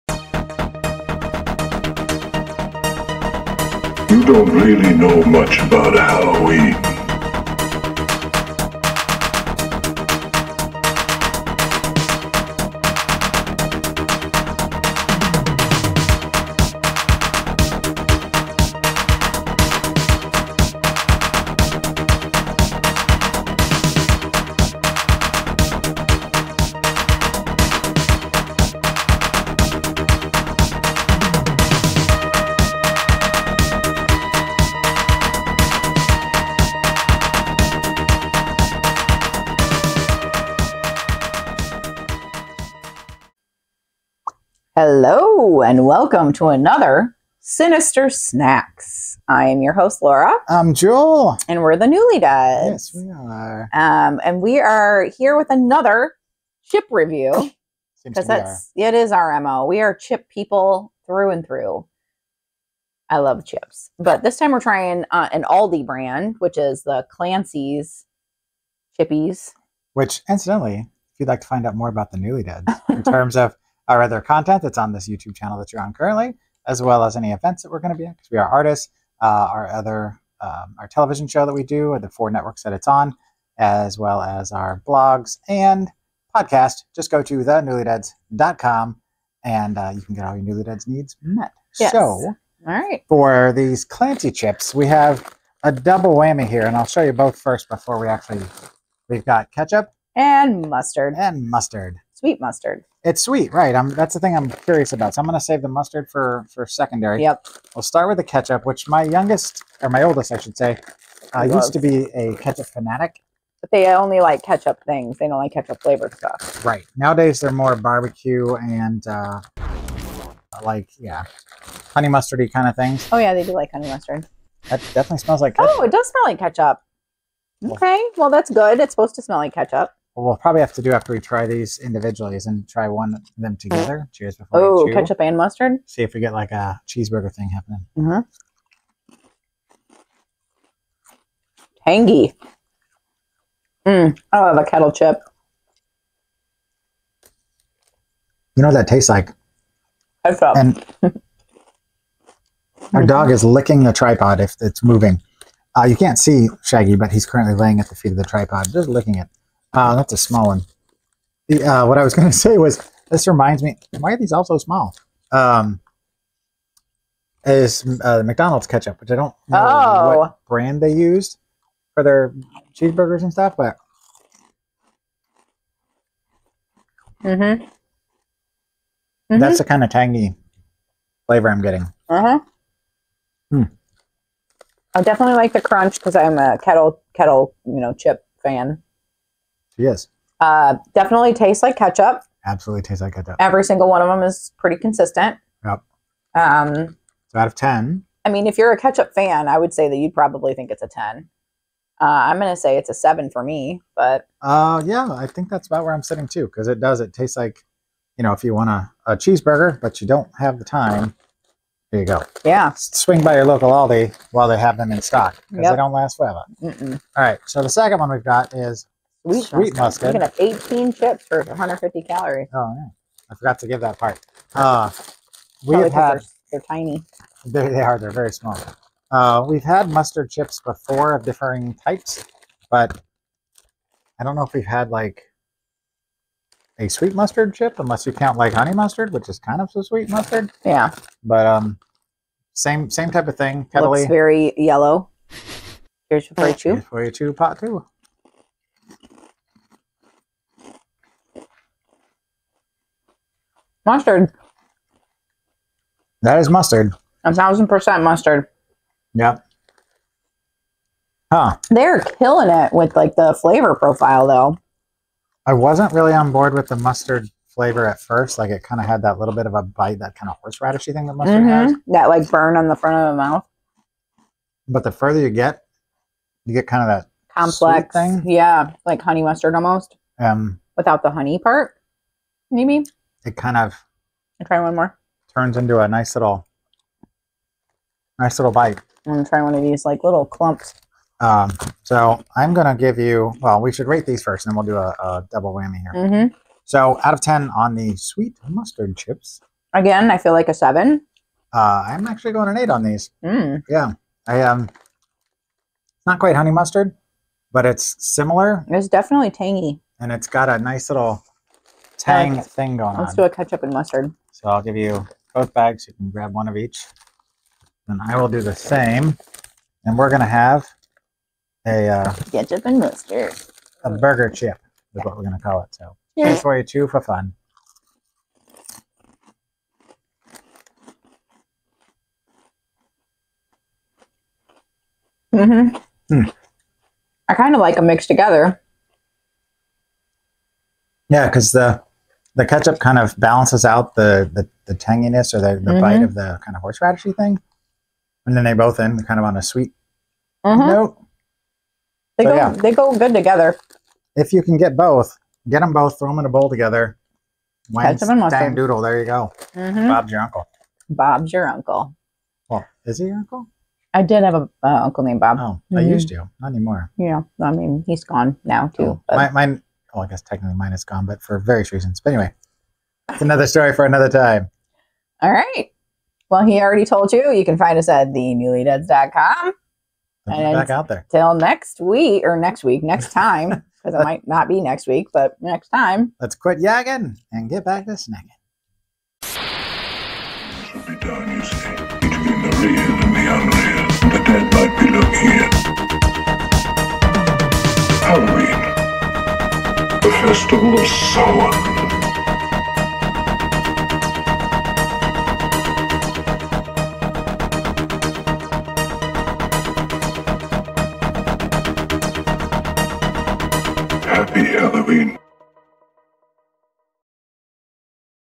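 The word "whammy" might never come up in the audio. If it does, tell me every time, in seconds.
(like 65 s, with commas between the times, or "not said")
96 s, 295 s.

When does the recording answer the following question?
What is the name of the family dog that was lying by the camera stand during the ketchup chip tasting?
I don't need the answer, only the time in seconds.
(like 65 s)
156 s.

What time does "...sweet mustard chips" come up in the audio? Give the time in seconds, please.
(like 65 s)
297 s.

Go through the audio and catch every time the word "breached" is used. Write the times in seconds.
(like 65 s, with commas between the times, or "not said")
not said.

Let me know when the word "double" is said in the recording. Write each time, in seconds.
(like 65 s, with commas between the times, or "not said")
95 s, 295 s.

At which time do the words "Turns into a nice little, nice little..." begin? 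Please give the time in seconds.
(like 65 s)
285 s.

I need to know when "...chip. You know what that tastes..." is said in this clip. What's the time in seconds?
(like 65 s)
144 s.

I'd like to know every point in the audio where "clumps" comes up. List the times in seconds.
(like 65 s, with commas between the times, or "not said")
290 s.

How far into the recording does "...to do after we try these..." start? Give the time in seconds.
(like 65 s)
130 s.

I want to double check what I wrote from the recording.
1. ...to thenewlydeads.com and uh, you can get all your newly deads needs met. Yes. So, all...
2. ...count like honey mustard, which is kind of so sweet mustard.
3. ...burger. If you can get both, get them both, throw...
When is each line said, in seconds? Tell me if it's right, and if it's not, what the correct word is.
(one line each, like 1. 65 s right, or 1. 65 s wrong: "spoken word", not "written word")
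1. 87 s right
2. 238 s right
3. 353 s wrong: "together", not "burger".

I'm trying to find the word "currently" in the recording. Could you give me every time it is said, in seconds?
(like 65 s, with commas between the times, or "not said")
75 s, 157 s.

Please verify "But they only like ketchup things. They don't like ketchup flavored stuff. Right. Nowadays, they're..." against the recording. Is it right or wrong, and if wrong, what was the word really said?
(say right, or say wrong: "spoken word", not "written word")
right.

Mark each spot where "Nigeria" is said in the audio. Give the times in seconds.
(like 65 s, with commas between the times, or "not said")
not said.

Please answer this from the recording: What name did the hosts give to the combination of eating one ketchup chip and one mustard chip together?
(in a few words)
burger chip.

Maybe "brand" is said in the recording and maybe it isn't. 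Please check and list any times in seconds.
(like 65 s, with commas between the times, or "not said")
65 s, 170 s.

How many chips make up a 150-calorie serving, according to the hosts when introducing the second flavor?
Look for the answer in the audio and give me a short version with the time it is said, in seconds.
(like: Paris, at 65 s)
18, at 220 s.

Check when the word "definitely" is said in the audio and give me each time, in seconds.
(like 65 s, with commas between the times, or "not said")
124 s, 185 s, 190 s, 308 s.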